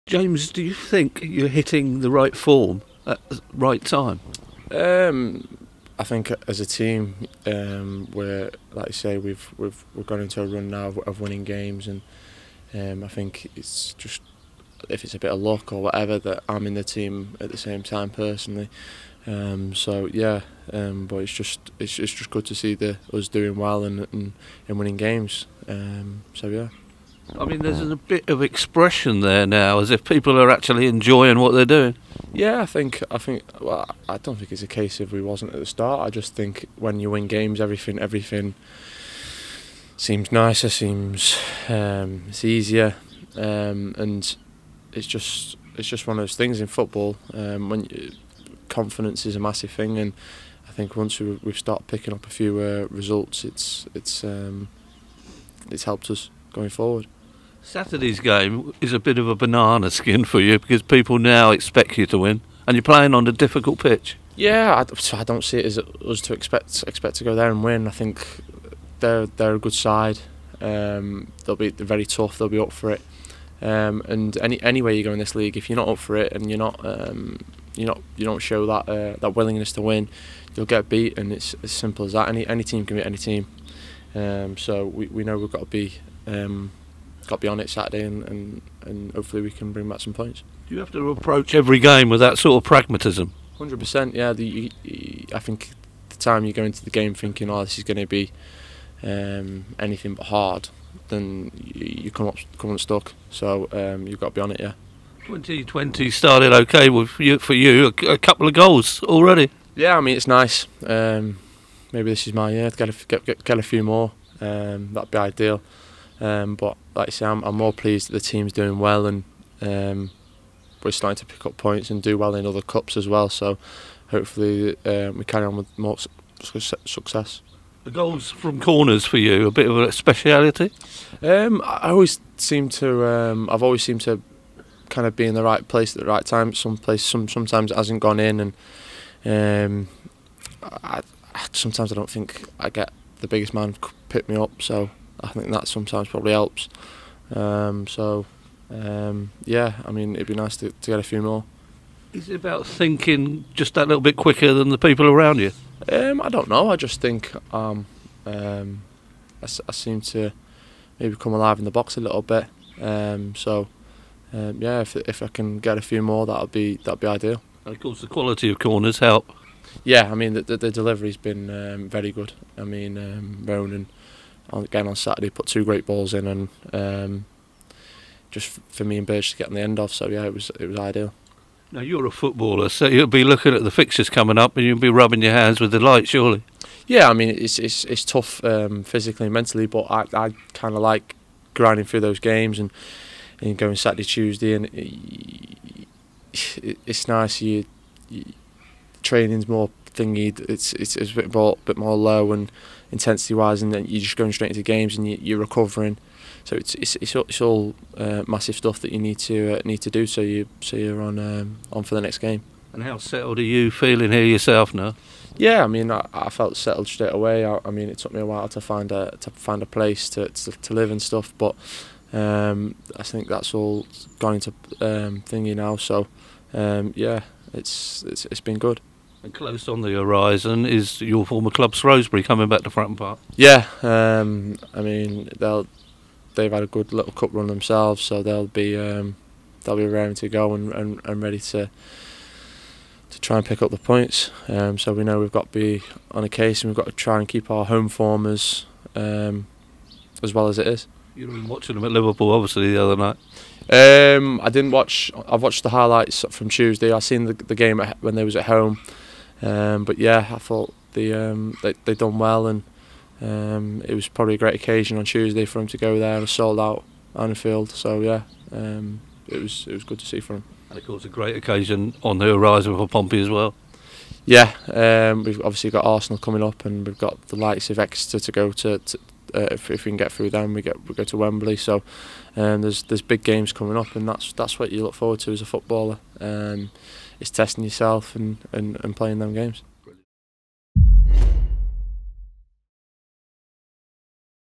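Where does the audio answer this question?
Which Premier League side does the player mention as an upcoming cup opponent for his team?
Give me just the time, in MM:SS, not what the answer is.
04:35.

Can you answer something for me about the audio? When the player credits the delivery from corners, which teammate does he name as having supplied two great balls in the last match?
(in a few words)
Ronan.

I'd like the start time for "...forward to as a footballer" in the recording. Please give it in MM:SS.
04:44.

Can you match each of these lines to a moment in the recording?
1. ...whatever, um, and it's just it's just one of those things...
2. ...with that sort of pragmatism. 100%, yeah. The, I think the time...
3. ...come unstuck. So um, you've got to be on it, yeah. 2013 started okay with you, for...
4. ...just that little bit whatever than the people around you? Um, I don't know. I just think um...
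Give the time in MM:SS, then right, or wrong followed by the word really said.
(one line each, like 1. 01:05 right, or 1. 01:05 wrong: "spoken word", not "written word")
1. 00:42 wrong: "easier", not "whatever"
2. 01:32 right
3. 01:42 wrong: "2020", not "2013"
4. 02:33 wrong: "quicker", not "whatever".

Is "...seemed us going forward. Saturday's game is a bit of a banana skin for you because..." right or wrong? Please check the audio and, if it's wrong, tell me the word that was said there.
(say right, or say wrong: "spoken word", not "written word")
wrong: "helped", not "seemed".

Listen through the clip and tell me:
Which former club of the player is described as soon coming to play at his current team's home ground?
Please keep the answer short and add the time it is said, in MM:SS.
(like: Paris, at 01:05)
Shrewsbury, at 03:51.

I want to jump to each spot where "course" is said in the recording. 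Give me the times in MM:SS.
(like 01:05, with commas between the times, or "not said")
02:47, 04:30.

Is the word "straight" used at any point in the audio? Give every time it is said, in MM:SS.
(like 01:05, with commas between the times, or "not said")
03:24, 03:36.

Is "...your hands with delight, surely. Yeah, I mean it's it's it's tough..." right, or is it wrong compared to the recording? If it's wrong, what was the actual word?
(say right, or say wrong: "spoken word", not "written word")
right.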